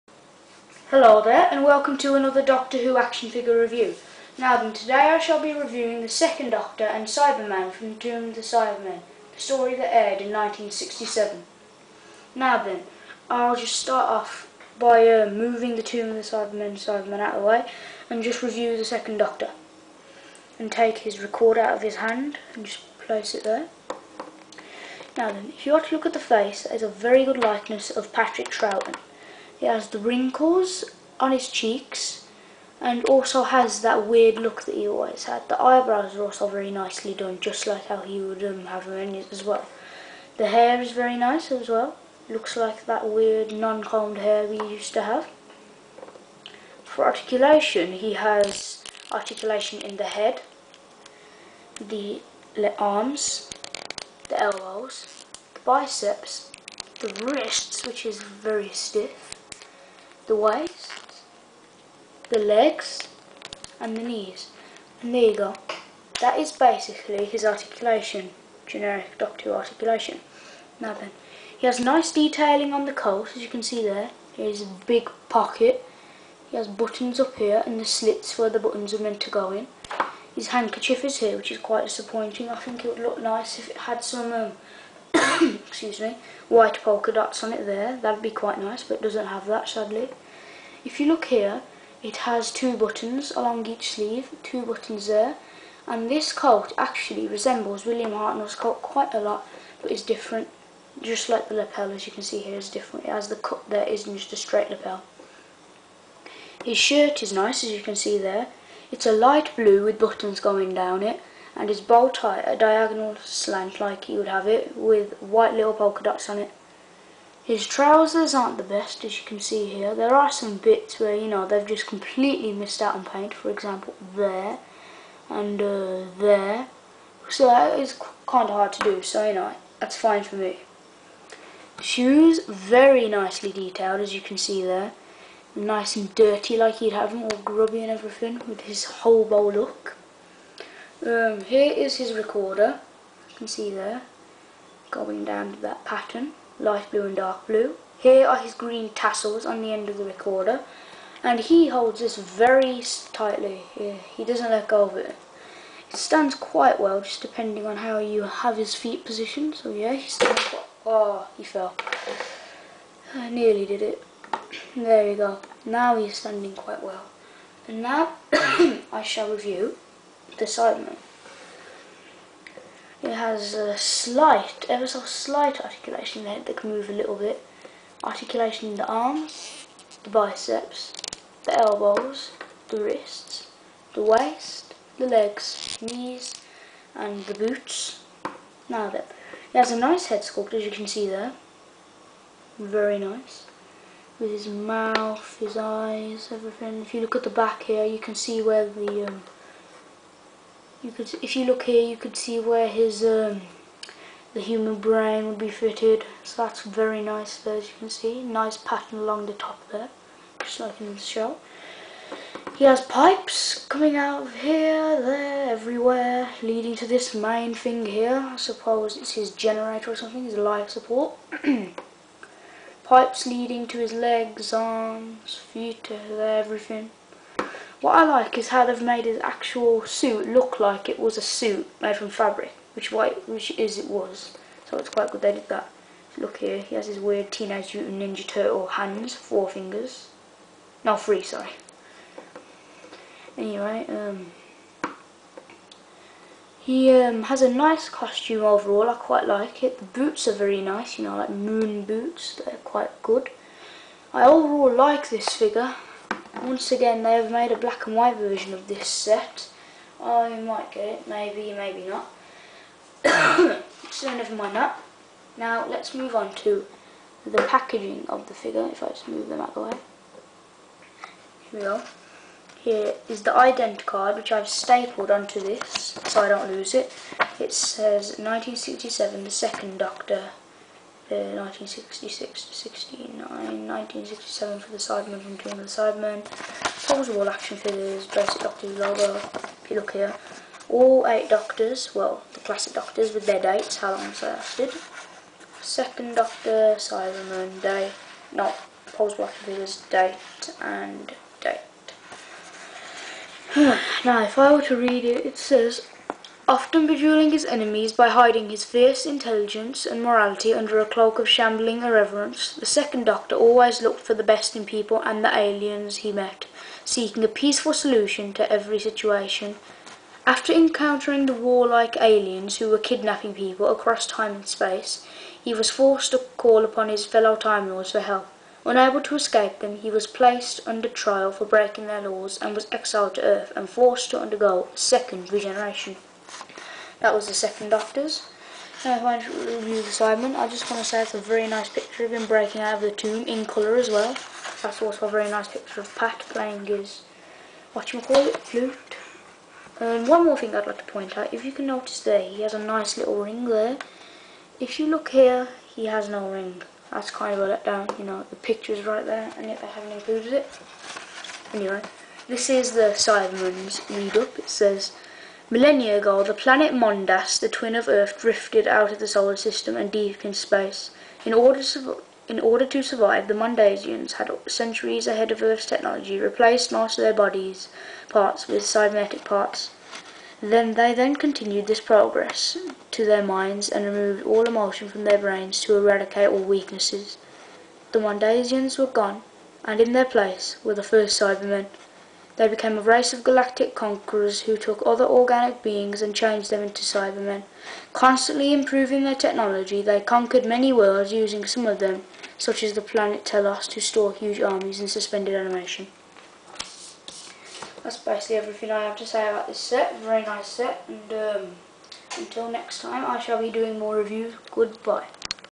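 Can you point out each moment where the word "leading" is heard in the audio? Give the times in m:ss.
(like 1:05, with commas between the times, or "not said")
3:36, 3:43.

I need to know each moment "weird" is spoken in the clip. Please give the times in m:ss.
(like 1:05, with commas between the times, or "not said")
0:34, 0:43, 3:56.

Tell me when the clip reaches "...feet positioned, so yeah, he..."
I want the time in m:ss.
2:38.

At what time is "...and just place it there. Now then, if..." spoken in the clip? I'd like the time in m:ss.
0:22.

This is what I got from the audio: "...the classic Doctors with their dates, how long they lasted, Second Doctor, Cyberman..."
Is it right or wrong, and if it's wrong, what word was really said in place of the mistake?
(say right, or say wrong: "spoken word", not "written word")
right.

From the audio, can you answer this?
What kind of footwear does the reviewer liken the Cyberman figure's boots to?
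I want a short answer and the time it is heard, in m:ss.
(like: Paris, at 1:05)
Moon boots, at 4:11.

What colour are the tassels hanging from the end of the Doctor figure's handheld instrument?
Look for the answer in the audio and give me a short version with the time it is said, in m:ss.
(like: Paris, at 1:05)
Green, at 2:28.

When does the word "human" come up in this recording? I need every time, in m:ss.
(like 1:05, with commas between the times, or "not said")
3:24.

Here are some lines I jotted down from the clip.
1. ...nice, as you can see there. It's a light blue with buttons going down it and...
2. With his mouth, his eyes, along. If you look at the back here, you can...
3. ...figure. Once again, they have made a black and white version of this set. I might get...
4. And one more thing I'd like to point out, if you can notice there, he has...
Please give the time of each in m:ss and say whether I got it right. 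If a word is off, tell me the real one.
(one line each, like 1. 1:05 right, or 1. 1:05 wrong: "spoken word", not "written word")
1. 1:47 right
2. 3:14 wrong: "everything", not "along"
3. 4:15 right
4. 5:49 right.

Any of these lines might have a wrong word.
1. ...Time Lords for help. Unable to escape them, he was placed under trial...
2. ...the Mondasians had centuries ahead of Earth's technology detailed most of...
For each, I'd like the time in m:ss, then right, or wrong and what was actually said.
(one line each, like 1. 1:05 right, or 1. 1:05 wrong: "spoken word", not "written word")
1. 5:27 right
2. 6:13 wrong: "replaced", not "detailed".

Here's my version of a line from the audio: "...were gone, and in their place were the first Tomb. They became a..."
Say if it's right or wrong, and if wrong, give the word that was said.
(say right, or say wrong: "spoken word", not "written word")
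wrong: "Cybermen", not "Tomb".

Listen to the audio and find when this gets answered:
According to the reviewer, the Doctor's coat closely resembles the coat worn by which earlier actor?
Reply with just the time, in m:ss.
1:37.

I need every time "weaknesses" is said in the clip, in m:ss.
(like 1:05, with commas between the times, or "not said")
6:26.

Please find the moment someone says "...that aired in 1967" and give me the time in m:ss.
0:09.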